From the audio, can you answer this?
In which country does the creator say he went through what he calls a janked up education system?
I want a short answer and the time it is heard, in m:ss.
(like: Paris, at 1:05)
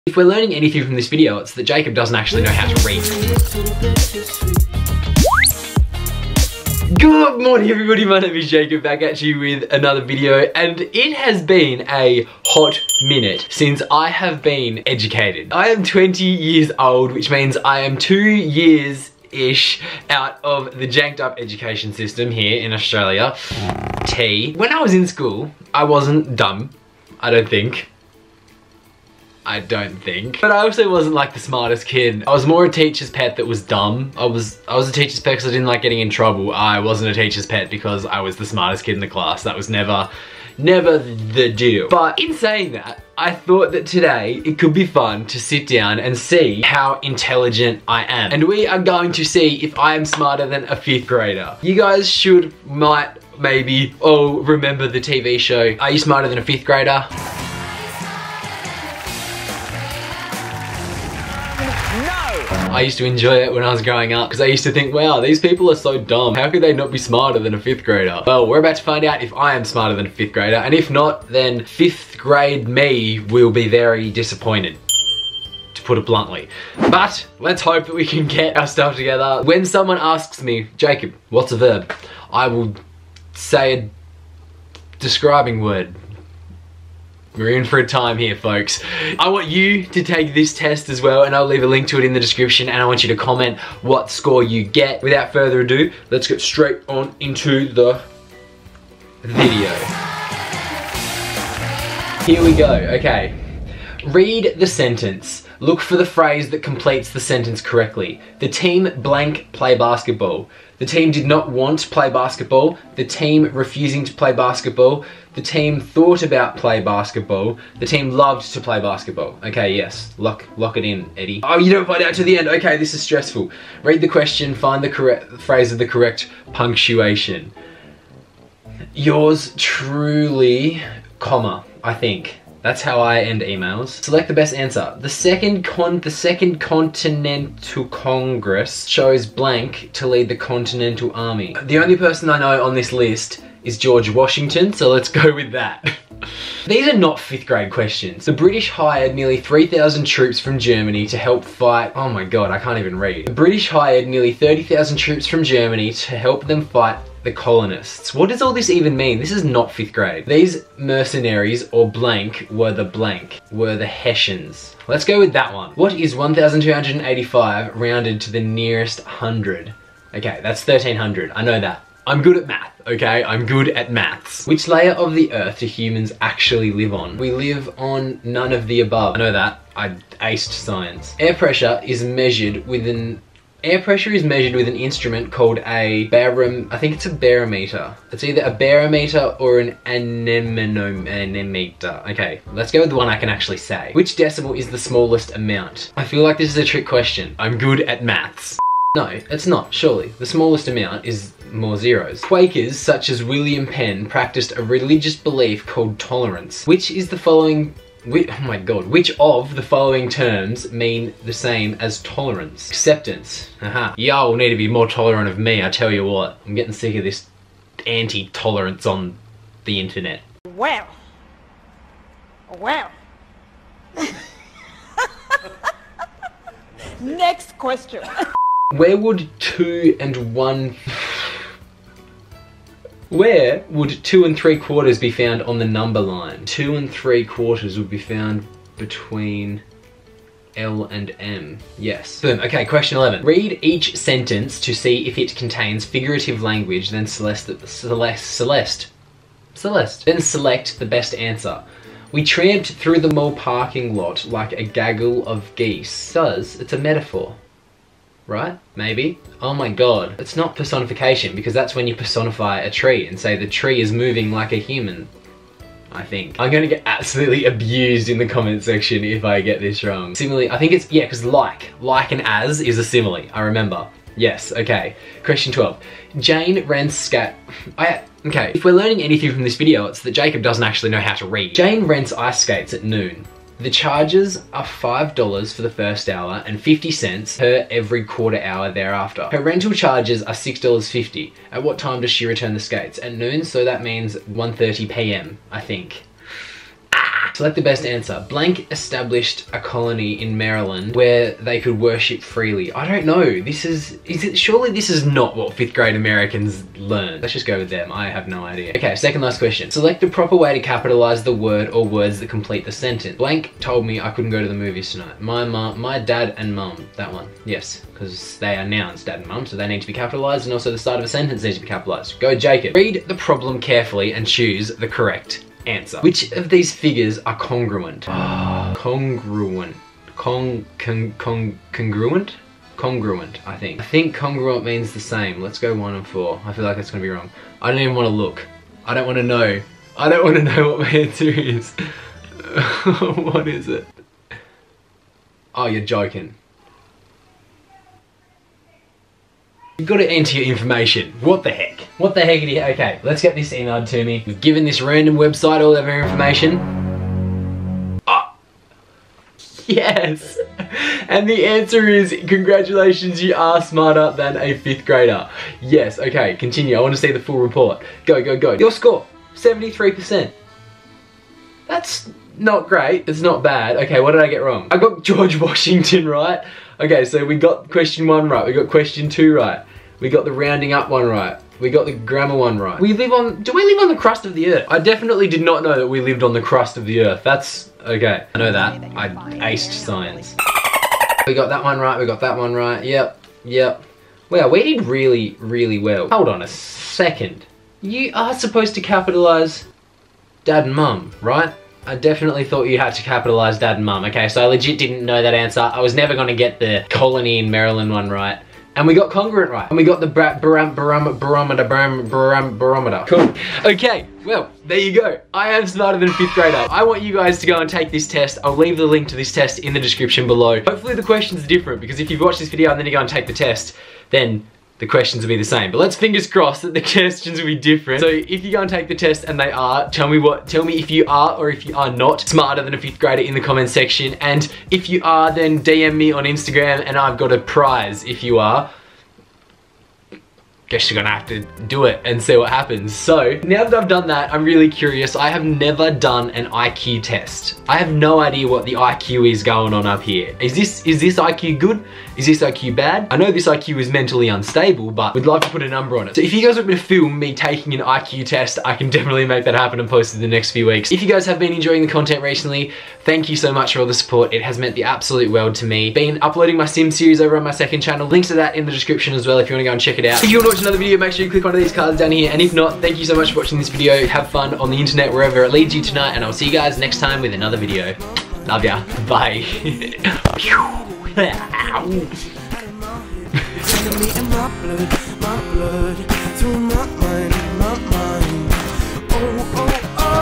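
Australia, at 0:22.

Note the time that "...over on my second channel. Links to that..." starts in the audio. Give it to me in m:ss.
7:47.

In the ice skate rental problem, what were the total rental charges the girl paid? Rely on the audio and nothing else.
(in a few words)
$6.50.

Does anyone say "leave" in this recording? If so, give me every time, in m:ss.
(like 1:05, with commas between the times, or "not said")
1:31, 6:58.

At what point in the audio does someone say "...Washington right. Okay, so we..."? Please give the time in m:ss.
6:15.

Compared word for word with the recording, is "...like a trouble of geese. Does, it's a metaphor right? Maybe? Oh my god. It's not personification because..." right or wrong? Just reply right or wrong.
wrong.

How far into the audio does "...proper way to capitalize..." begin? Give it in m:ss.
5:10.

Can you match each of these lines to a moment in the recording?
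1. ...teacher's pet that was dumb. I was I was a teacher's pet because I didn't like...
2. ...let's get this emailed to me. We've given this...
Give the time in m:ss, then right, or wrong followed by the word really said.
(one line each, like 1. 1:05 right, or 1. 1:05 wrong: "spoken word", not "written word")
1. 0:32 right
2. 5:53 right.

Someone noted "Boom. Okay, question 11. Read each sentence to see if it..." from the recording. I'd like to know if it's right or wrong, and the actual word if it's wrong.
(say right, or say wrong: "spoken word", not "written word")
right.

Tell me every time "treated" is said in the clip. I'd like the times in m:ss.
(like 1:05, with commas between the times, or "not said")
not said.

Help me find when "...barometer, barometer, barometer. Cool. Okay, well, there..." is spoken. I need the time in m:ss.
6:50.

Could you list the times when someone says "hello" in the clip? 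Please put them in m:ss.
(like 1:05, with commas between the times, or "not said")
not said.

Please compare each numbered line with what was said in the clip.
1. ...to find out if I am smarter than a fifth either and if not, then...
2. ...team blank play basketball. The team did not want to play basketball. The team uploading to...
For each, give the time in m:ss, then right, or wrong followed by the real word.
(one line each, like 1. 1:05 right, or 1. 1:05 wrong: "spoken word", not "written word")
1. 1:08 wrong: "grader", not "either"
2. 1:48 wrong: "refusing", not "uploading".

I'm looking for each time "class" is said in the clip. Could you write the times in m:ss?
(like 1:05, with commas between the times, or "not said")
0:39.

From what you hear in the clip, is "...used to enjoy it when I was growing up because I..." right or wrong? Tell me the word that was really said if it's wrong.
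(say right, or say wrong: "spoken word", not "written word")
right.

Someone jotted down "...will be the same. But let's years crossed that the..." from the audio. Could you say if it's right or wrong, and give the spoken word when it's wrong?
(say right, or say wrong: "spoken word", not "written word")
wrong: "fingers", not "years".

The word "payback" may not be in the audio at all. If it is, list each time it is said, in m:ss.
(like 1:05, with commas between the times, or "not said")
not said.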